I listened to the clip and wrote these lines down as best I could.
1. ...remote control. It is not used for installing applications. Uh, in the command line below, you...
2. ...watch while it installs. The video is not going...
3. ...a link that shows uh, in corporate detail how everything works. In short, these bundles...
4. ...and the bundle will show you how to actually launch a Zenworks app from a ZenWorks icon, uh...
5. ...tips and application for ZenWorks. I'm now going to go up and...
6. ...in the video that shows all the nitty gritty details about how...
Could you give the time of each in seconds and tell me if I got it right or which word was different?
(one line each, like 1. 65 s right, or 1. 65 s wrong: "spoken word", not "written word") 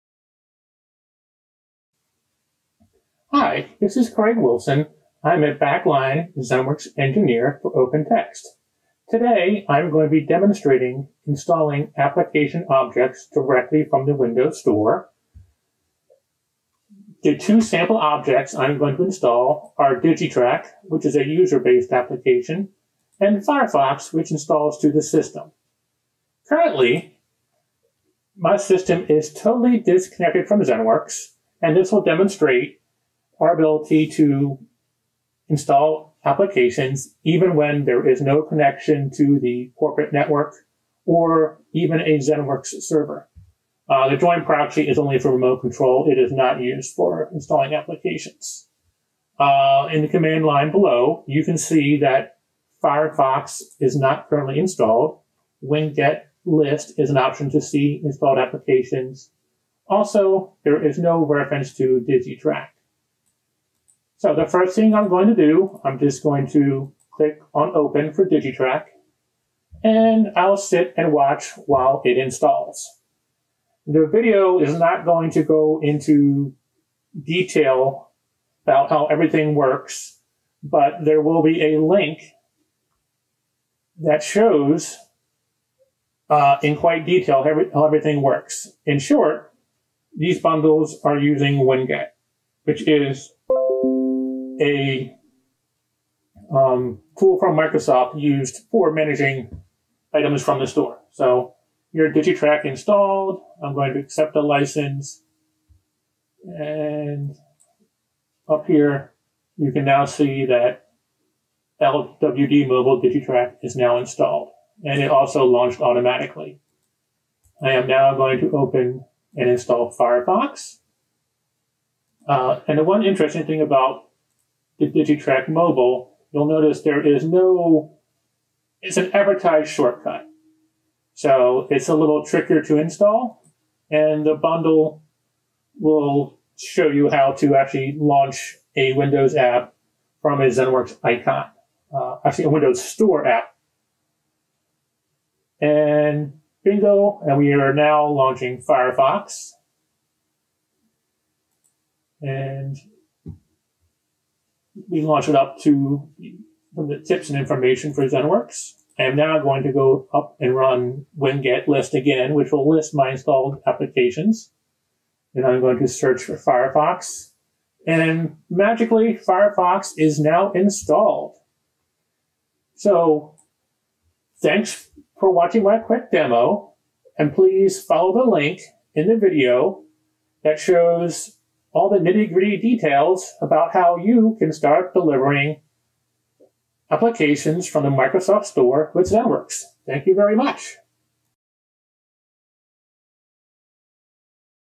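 1. 45 s right
2. 71 s right
3. 81 s wrong: "quite", not "corporate"
4. 133 s wrong: "Windows", not "Zenworks"
5. 157 s wrong: "information", not "application"
6. 178 s right.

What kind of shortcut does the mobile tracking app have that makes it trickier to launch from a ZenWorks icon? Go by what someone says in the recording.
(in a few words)
Advertised shortcut.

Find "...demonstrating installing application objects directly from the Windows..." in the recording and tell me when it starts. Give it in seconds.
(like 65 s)
10 s.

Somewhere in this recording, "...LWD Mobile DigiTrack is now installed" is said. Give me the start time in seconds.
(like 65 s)
111 s.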